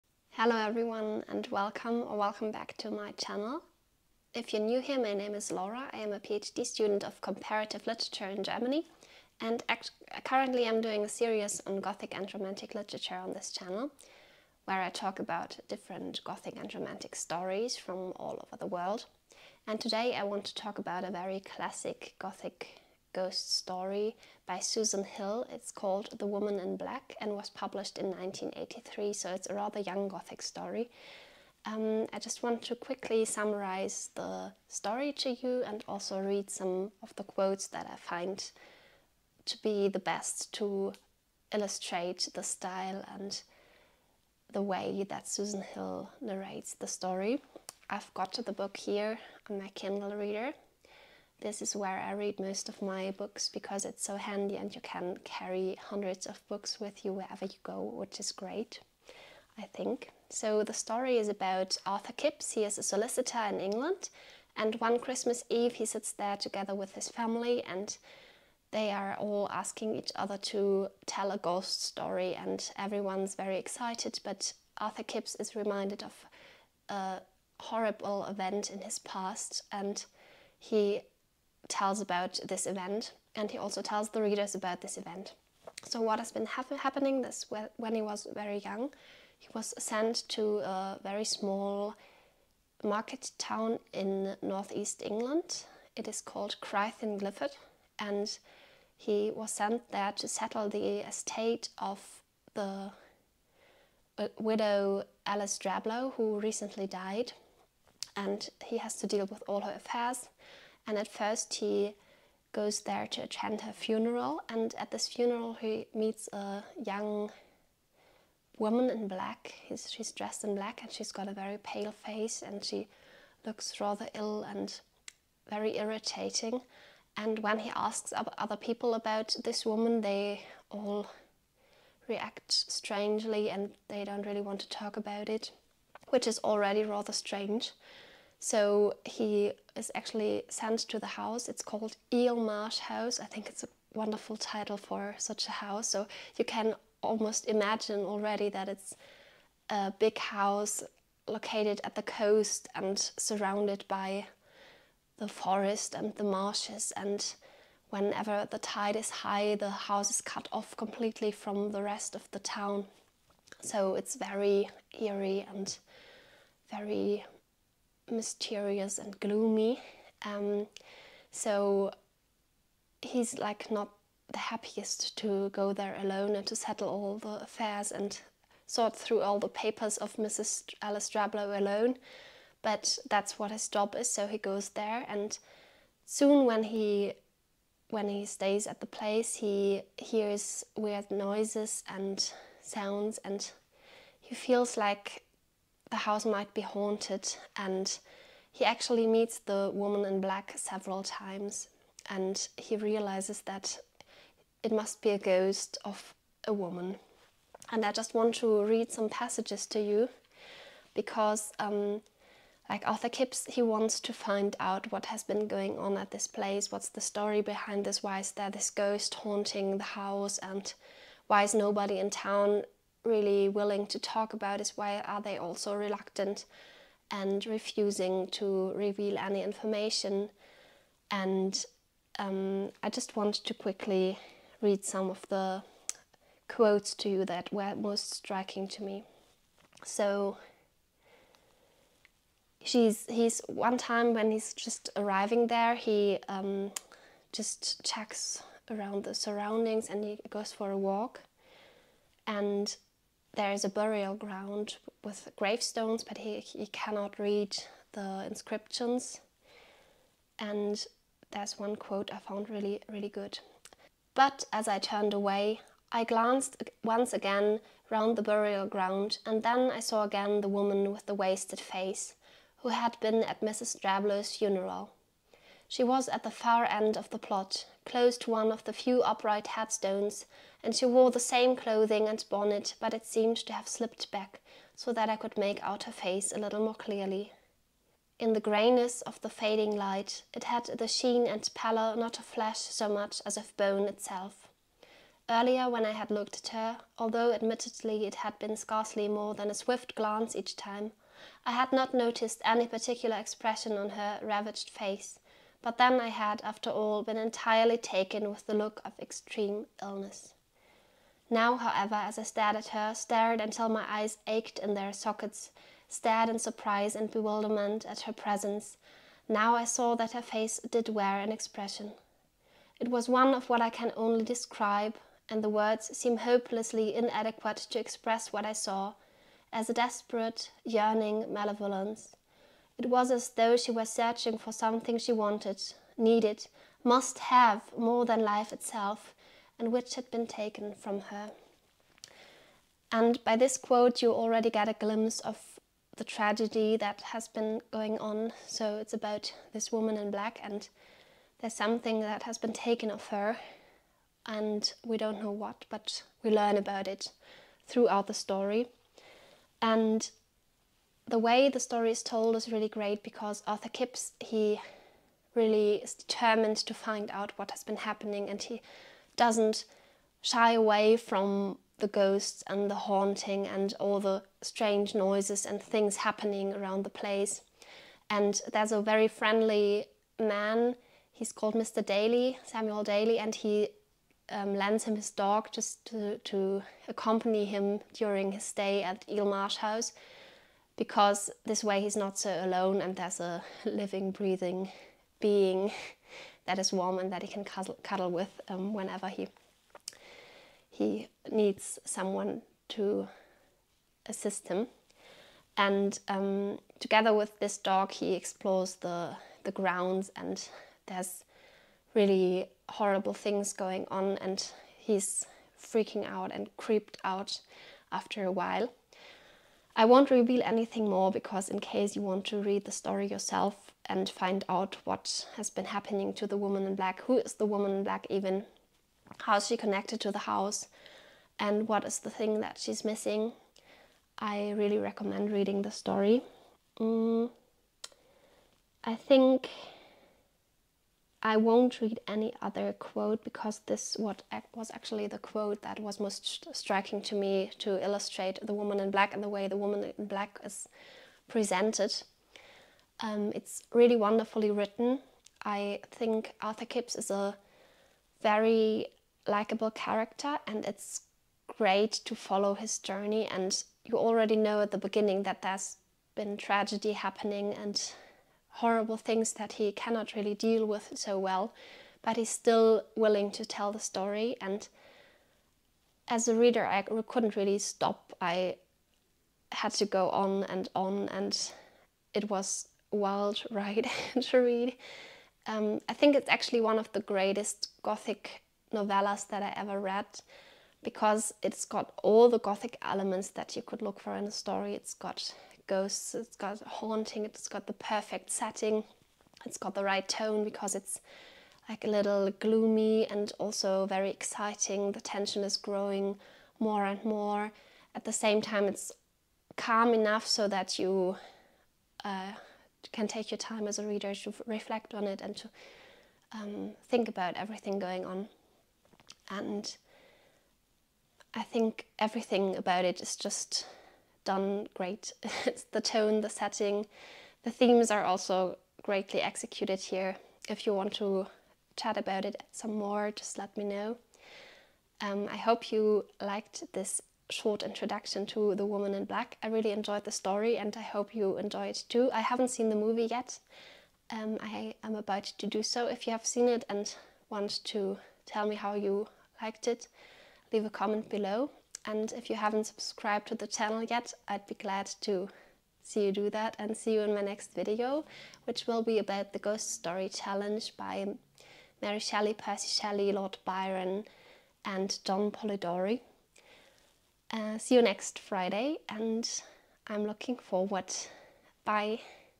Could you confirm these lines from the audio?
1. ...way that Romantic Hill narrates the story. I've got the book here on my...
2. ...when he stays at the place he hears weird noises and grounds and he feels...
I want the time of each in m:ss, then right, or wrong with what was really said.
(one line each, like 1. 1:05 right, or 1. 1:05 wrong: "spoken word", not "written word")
1. 0:44 wrong: "Susan", not "Romantic"
2. 3:07 wrong: "sounds", not "grounds".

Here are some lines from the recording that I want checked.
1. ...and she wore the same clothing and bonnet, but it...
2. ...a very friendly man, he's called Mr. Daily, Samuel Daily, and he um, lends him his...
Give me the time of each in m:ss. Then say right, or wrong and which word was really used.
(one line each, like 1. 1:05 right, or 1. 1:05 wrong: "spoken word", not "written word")
1. 4:40 right
2. 6:18 right.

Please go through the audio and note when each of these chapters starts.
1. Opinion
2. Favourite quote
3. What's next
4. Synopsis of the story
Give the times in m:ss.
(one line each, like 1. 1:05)
1. 5:43
2. 4:00
3. 9:16
4. 1:00.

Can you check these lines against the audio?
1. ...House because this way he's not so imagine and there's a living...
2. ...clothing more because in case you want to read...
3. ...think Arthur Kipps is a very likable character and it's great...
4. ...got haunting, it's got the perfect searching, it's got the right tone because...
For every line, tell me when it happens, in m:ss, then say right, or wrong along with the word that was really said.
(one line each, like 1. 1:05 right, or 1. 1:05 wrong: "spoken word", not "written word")
1. 6:29 wrong: "alone", not "imagine"
2. 7:00 wrong: "anything", not "clothing"
3. 7:35 right
4. 8:16 wrong: "setting", not "searching".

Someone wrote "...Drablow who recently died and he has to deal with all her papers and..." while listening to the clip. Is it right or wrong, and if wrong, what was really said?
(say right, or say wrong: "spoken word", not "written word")
wrong: "affairs", not "papers".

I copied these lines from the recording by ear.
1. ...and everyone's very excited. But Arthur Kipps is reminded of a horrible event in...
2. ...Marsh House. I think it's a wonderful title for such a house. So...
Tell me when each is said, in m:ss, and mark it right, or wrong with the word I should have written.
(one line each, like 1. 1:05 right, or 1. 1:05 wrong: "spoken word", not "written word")
1. 1:12 right
2. 2:22 right.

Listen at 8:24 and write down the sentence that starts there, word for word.
The tension is growing more and more.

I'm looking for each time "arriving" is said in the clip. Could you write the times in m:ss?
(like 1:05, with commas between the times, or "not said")
4:04.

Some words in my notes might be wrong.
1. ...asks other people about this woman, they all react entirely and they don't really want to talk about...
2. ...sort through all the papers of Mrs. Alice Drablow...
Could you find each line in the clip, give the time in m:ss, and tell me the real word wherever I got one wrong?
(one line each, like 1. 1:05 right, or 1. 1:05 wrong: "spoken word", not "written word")
1. 2:07 wrong: "strangely", not "entirely"
2. 2:58 right.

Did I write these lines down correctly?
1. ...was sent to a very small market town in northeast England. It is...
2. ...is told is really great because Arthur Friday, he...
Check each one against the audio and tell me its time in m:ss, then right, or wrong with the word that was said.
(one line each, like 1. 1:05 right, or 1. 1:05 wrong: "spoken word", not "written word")
1. 1:29 right
2. 6:01 wrong: "Kipps", not "Friday".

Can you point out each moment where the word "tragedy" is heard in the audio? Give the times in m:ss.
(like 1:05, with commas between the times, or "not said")
5:46, 7:46.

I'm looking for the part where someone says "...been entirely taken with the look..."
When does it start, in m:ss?
5:07.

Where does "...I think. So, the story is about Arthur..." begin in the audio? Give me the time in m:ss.
0:59.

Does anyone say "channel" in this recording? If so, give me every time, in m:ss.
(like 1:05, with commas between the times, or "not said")
0:03, 0:13, 9:13.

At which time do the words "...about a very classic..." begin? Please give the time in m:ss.
0:20.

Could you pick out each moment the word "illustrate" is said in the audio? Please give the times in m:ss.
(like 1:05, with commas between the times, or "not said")
0:41, 7:27.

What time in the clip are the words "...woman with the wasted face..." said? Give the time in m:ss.
4:30.